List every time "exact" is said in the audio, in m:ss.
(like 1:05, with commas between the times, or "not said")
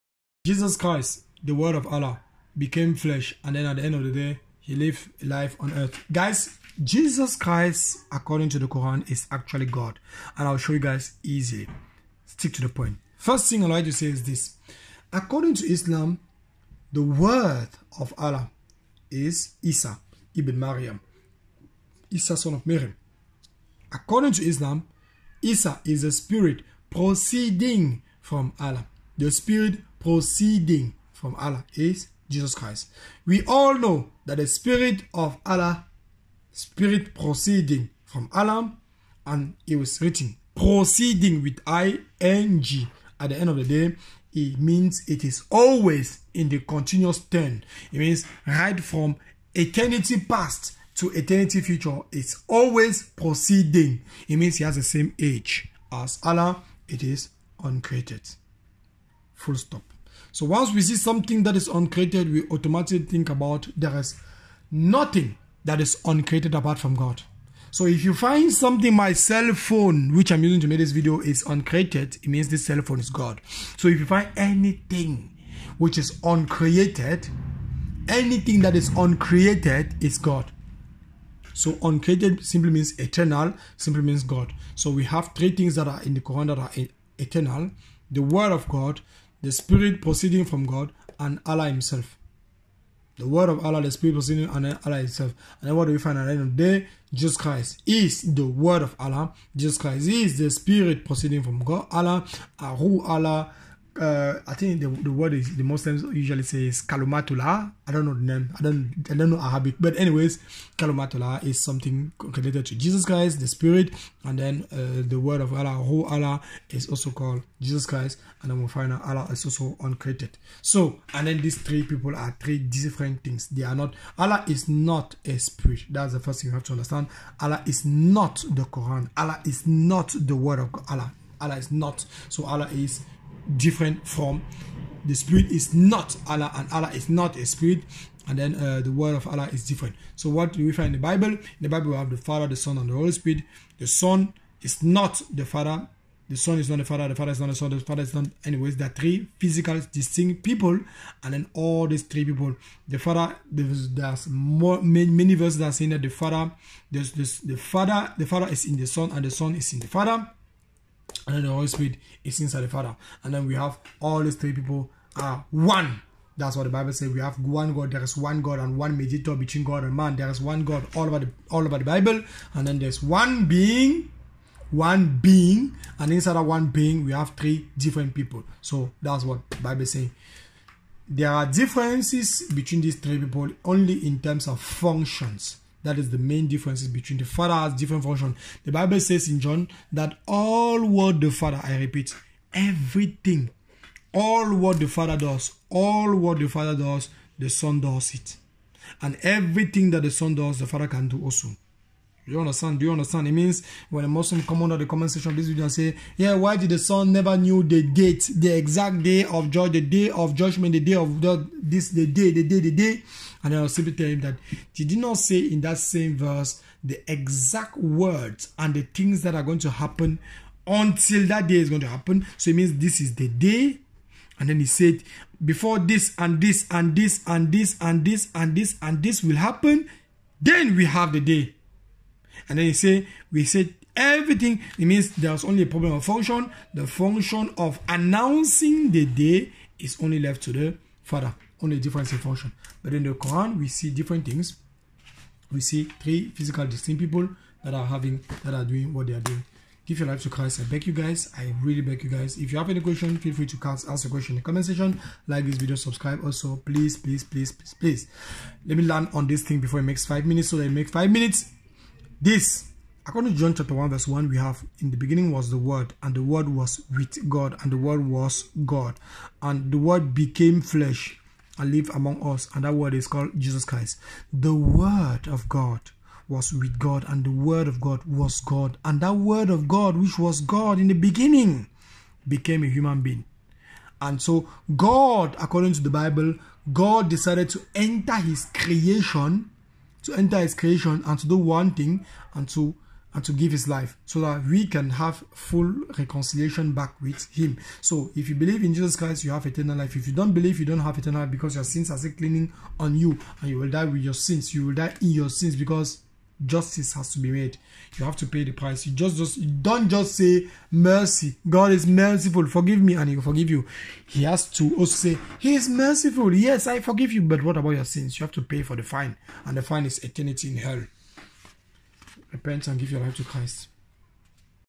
3:28, 3:37.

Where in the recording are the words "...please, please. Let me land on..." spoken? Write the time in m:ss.
4:17.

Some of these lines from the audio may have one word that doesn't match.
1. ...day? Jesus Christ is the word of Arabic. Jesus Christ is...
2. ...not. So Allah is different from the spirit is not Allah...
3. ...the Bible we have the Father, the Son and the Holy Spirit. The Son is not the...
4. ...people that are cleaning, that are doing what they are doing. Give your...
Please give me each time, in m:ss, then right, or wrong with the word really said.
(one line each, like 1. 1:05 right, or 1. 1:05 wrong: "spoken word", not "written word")
1. 1:36 wrong: "Allah", not "Arabic"
2. 2:11 right
3. 2:21 right
4. 4:07 wrong: "having", not "cleaning".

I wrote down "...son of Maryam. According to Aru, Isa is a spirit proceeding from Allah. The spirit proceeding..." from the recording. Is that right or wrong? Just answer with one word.
wrong.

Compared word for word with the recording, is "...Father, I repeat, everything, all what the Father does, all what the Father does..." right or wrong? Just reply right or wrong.
right.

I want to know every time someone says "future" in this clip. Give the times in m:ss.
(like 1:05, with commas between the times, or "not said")
0:51.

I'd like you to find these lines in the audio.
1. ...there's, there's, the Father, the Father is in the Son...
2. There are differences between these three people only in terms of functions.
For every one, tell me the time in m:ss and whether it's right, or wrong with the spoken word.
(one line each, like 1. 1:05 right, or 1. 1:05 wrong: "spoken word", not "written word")
1. 2:36 right
2. 3:01 right.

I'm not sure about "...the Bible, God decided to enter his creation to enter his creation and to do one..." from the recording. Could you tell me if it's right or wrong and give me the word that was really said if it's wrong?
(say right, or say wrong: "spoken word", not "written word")
right.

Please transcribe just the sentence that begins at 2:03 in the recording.
They are not Allah is not a spirit.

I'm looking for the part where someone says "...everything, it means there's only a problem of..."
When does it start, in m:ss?
3:53.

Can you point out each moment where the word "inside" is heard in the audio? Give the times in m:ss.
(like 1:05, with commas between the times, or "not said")
2:42, 2:56.